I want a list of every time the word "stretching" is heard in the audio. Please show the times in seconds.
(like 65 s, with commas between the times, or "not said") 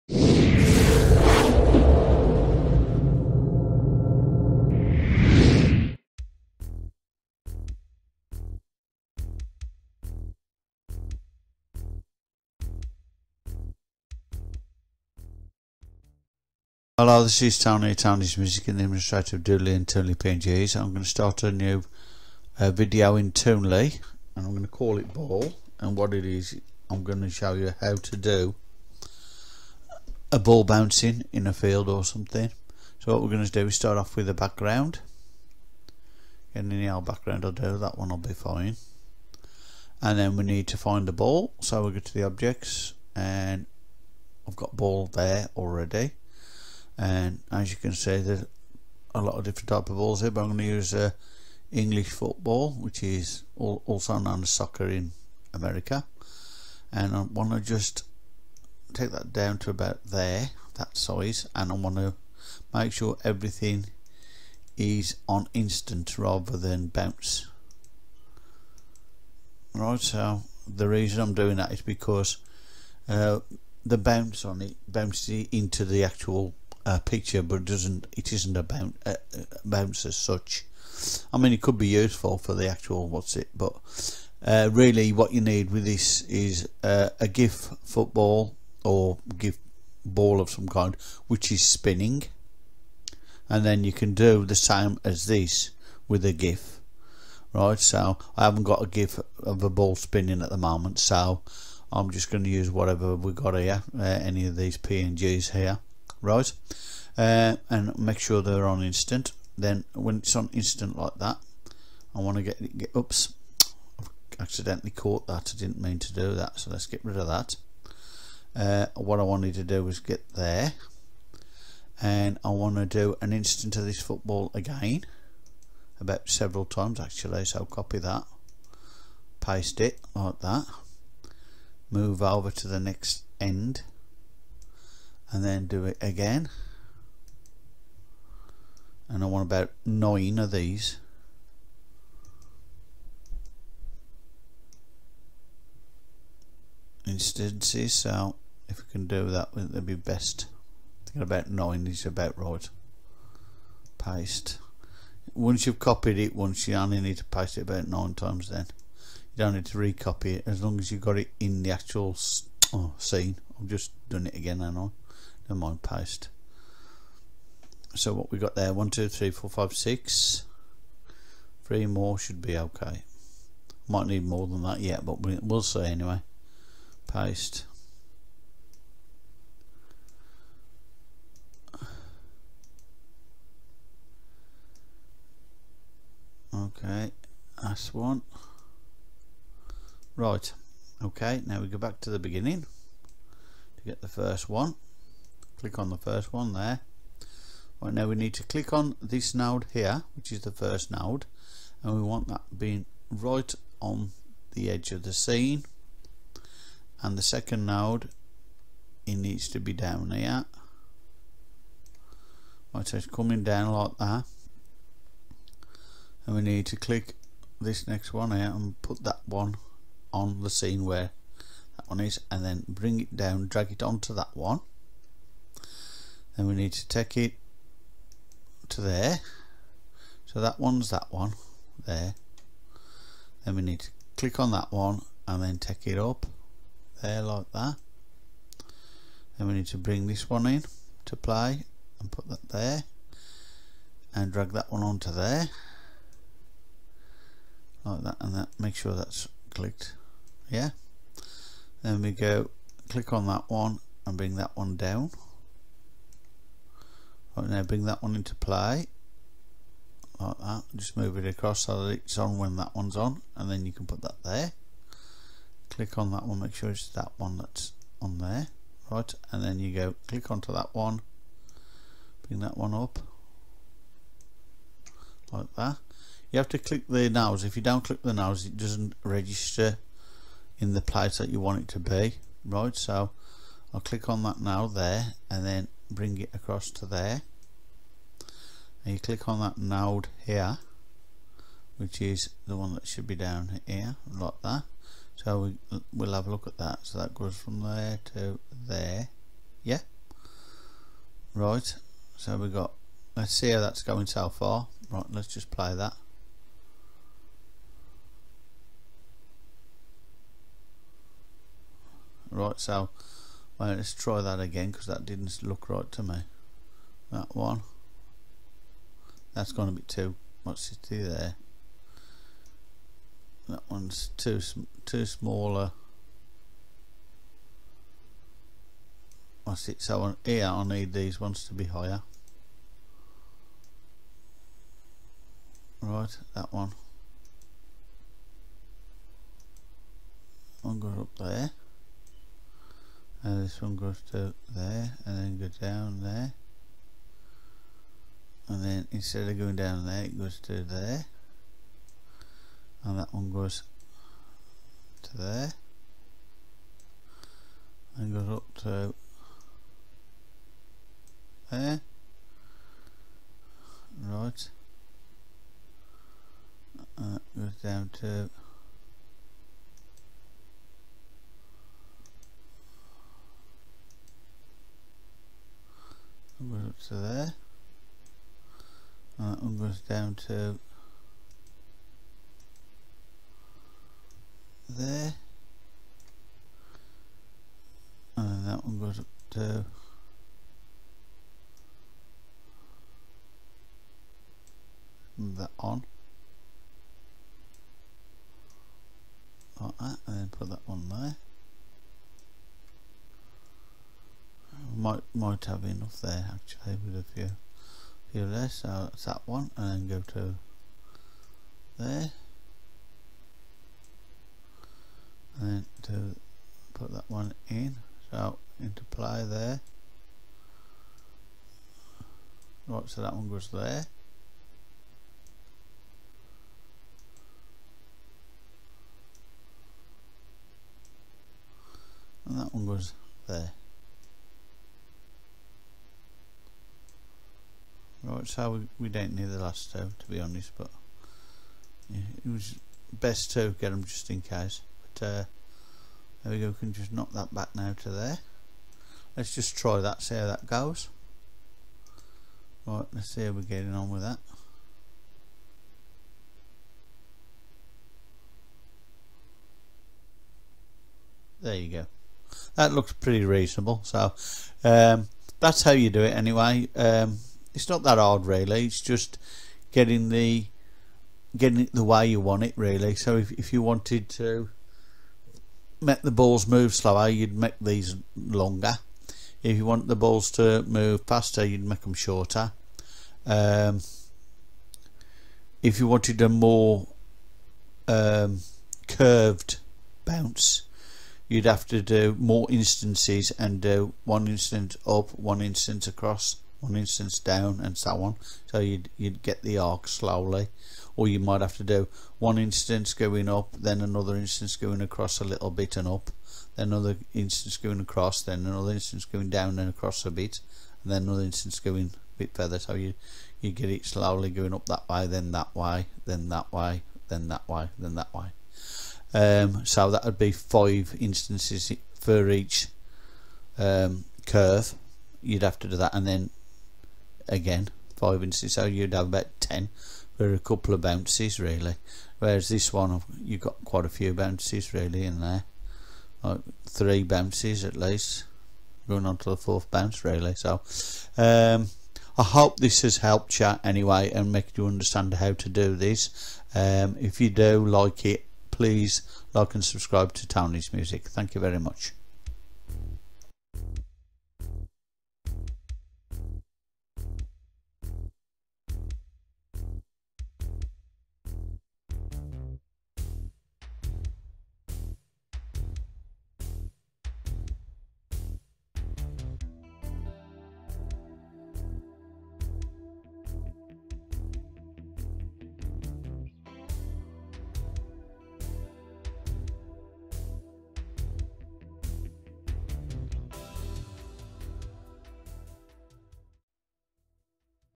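not said.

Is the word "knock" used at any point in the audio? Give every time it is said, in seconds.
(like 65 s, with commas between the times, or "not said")
446 s.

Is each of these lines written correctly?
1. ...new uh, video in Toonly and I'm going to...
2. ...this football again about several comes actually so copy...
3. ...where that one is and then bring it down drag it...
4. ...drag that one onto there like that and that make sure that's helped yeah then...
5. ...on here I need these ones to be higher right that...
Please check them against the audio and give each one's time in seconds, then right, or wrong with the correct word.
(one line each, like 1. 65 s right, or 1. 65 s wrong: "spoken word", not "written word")
1. 21 s right
2. 123 s wrong: "times", not "comes"
3. 220 s right
4. 244 s wrong: "clicked", not "helped"
5. 330 s right.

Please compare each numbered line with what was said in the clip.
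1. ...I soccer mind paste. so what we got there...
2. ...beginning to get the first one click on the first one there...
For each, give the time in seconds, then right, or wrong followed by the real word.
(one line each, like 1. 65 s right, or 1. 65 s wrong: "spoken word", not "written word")
1. 164 s wrong: "never", not "soccer"
2. 192 s right.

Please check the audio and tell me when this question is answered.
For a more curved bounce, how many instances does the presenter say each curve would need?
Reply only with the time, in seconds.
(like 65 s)
520 s.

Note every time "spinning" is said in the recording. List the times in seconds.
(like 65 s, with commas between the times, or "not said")
91 s, 99 s.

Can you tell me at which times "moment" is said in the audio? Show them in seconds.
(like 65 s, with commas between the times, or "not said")
100 s.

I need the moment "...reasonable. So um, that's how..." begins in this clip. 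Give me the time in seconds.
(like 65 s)
463 s.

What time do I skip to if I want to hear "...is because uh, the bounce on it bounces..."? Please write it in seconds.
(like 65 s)
71 s.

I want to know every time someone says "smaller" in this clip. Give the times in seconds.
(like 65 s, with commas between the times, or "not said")
325 s.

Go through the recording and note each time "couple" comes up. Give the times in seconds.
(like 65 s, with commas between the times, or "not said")
530 s.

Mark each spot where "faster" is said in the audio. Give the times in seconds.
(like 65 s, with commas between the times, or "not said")
481 s.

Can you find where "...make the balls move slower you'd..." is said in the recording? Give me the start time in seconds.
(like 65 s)
475 s.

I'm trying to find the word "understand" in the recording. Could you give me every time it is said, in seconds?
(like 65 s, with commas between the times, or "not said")
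544 s.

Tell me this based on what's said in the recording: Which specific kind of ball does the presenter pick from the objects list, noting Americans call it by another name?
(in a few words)
English football.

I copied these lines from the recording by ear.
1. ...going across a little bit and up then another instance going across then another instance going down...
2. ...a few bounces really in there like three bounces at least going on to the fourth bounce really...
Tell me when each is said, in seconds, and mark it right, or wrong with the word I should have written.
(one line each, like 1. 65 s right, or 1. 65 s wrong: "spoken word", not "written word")
1. 504 s right
2. 533 s right.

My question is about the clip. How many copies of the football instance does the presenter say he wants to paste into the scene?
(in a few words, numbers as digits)
9.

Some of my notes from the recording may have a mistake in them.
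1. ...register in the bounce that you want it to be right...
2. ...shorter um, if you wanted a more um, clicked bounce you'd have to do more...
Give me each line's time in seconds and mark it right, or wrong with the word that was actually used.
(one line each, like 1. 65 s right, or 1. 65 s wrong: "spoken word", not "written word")
1. 279 s wrong: "place", not "bounce"
2. 481 s wrong: "curved", not "clicked".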